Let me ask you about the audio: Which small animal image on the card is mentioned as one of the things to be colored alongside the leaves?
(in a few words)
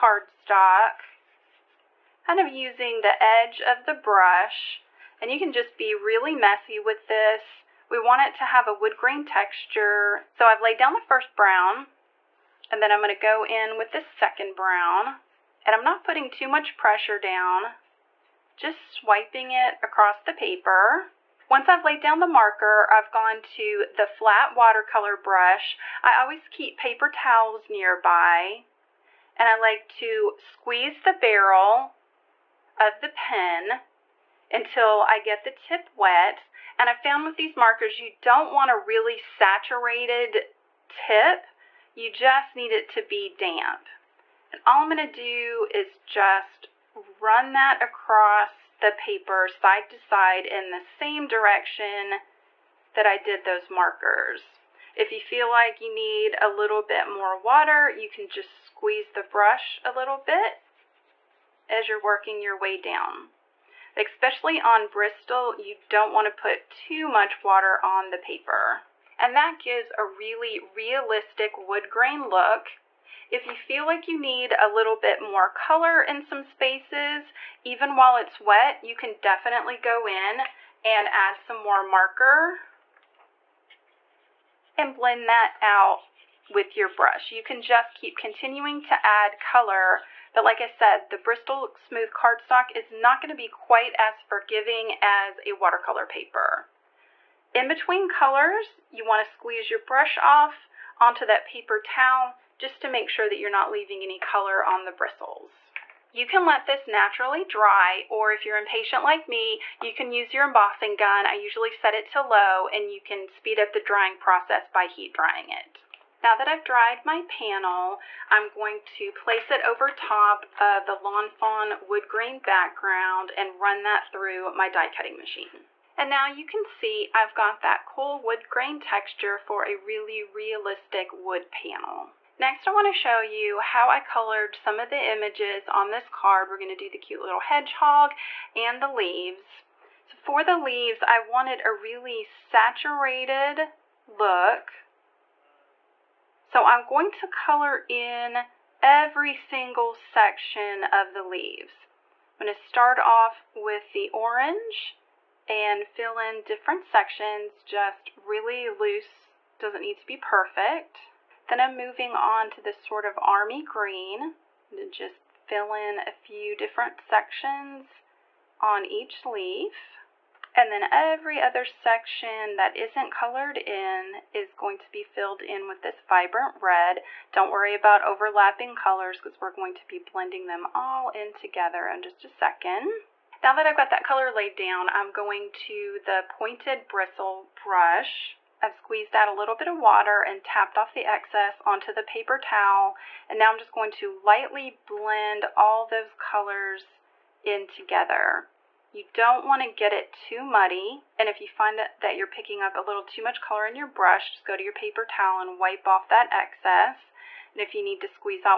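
hedgehog.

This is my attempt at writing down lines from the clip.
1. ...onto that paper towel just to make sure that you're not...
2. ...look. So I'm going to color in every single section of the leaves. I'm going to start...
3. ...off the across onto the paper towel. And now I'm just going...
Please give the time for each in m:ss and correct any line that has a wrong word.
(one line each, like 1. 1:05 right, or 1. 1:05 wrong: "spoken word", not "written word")
1. 1:40 right
2. 2:24 right
3. 3:10 wrong: "excess", not "across".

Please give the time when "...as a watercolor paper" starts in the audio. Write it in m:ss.
1:35.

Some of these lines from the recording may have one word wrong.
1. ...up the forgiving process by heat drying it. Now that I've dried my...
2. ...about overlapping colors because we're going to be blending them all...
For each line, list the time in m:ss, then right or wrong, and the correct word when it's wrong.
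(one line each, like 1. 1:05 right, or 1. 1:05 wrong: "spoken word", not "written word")
1. 1:53 wrong: "drying", not "forgiving"
2. 2:57 right.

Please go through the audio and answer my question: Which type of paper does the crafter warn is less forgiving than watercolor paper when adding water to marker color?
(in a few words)
Bristol Smooth cardstock.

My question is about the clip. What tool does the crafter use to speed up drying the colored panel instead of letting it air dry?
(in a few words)
embossing gun.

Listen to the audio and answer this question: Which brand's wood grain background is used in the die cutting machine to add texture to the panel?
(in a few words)
Lawn Fawn.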